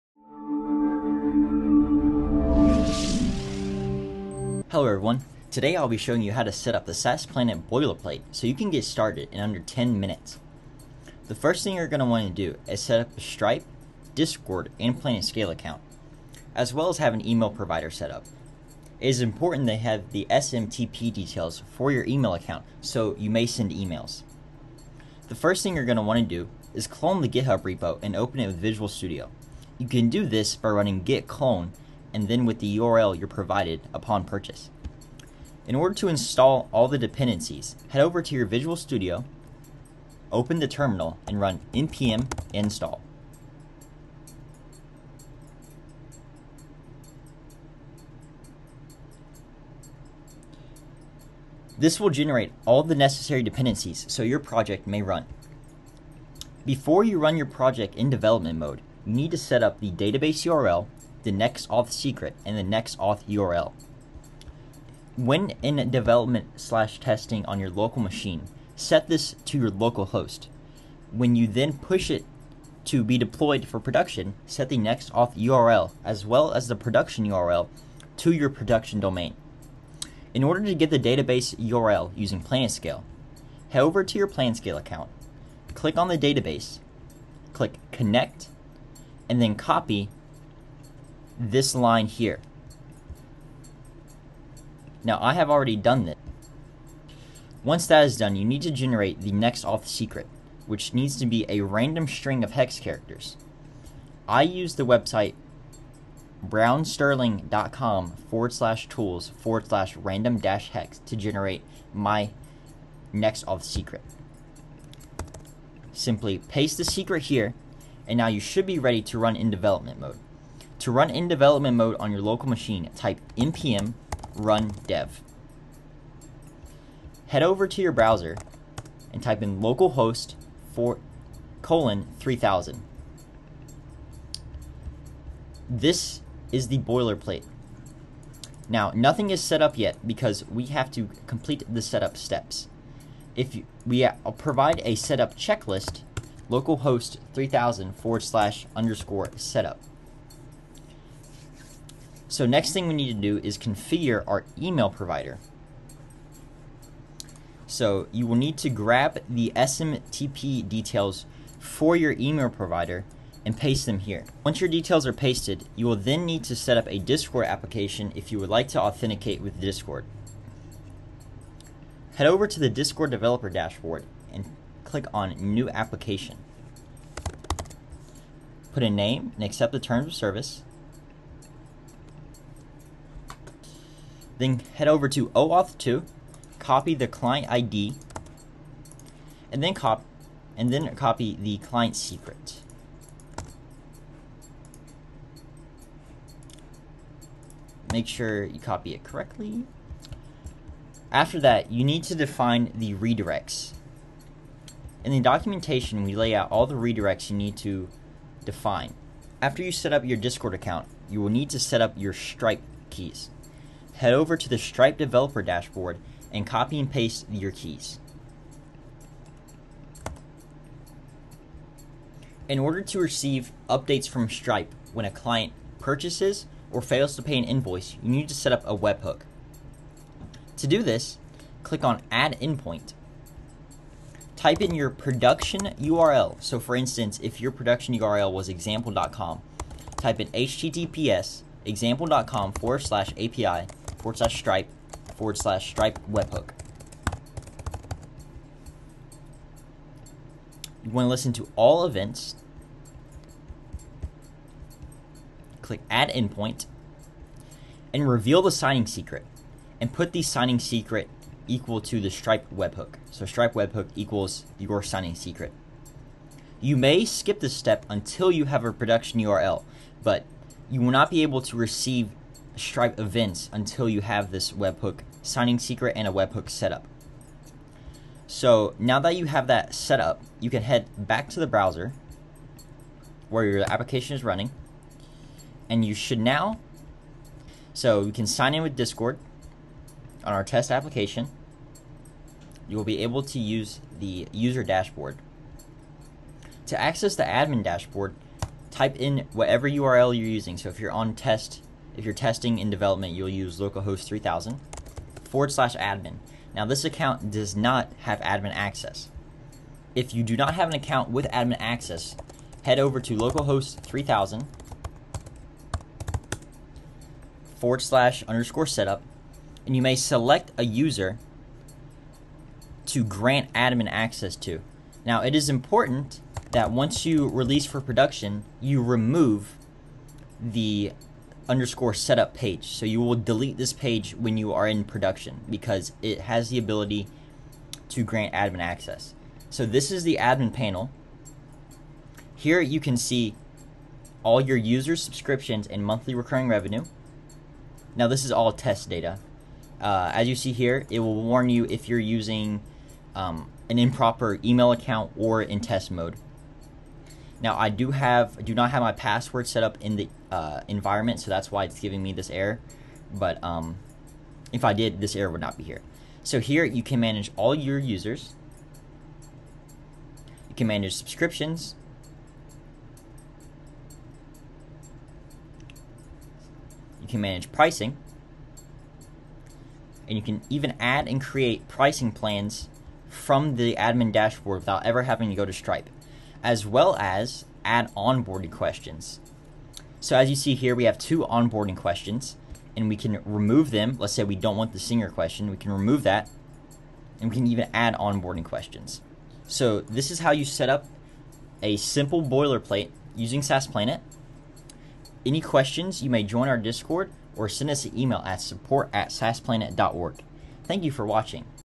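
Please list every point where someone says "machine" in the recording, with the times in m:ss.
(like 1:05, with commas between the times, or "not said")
1:08, 2:02.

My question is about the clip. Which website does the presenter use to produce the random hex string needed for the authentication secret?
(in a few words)
browserling.com.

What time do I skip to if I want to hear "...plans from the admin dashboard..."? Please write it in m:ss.
6:22.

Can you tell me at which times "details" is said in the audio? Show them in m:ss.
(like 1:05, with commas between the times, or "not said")
0:21, 2:40, 2:44.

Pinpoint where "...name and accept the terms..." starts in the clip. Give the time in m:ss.
2:58.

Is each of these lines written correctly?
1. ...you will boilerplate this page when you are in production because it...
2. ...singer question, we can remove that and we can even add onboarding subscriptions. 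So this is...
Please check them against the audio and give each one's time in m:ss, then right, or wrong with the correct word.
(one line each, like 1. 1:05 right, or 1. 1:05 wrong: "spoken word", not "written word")
1. 5:32 wrong: "delete", not "boilerplate"
2. 6:34 wrong: "questions", not "subscriptions".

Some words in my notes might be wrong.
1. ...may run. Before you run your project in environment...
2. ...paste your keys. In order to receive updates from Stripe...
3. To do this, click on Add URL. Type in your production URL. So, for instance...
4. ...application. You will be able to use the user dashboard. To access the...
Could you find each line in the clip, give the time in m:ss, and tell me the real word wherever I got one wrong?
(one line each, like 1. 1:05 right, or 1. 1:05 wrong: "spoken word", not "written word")
1. 0:54 wrong: "development", not "environment"
2. 3:36 right
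3. 3:50 wrong: "Endpoint", not "URL"
4. 4:50 right.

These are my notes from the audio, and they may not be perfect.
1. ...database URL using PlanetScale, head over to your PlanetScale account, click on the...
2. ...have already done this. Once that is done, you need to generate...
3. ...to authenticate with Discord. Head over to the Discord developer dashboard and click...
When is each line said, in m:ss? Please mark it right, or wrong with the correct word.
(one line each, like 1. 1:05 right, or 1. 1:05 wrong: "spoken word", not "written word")
1. 1:20 right
2. 1:35 right
3. 2:48 right.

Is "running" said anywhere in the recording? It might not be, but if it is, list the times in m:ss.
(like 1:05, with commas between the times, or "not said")
0:30, 4:44.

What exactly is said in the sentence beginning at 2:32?
So next thing we need to do is configure our email provider.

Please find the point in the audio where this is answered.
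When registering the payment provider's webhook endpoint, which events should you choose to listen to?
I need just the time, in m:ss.
4:11.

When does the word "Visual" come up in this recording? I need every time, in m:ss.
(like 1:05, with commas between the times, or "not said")
0:28, 0:38.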